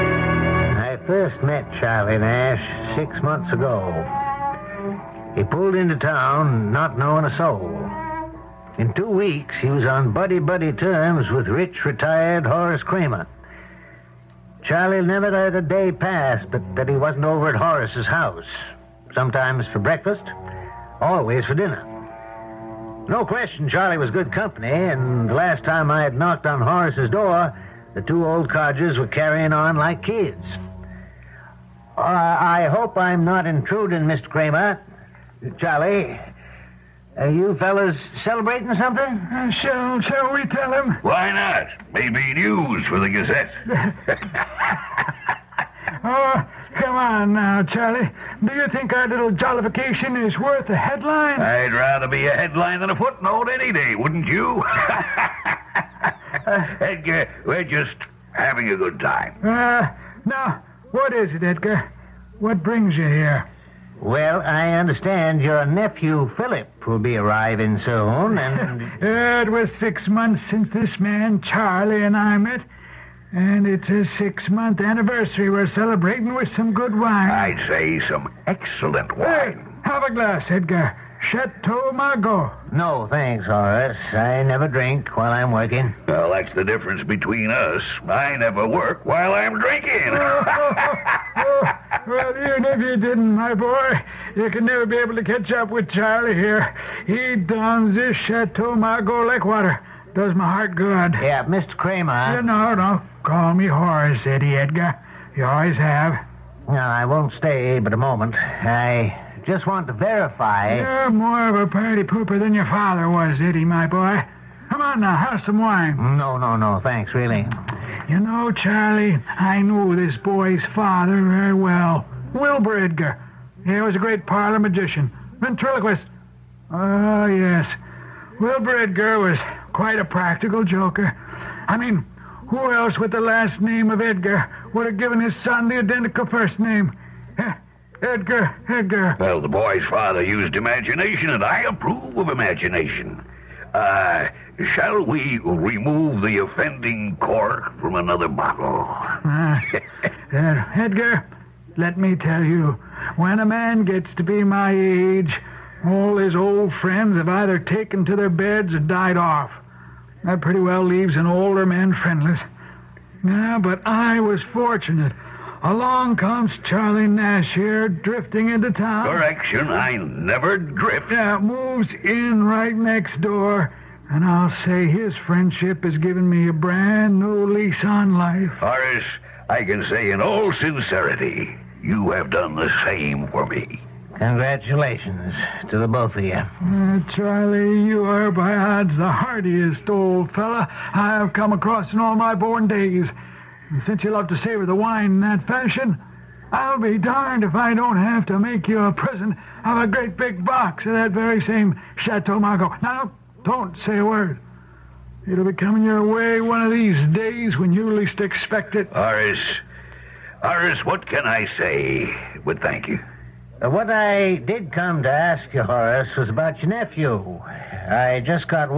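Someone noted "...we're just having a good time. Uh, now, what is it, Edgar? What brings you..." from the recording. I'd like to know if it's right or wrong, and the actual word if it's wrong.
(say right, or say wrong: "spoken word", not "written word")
right.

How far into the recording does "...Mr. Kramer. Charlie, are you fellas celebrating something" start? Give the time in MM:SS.
00:34.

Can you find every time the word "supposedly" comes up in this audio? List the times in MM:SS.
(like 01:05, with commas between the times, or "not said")
not said.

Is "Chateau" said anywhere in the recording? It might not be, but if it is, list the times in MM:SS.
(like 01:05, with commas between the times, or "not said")
01:21, 01:38, 03:22.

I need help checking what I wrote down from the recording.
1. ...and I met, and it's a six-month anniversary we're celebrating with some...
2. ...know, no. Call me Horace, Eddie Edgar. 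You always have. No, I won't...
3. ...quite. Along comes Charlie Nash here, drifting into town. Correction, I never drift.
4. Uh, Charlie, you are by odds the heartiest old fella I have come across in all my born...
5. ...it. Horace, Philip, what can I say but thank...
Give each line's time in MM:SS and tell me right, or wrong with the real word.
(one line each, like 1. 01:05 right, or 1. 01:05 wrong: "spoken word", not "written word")
1. 01:12 right
2. 01:42 right
3. 02:44 wrong: "fortunate", not "quite"
4. 03:06 right
5. 03:28 wrong: "Horace", not "Philip".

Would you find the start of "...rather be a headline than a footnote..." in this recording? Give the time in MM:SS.
00:51.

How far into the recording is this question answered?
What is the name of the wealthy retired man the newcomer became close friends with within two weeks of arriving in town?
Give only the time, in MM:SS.
00:12.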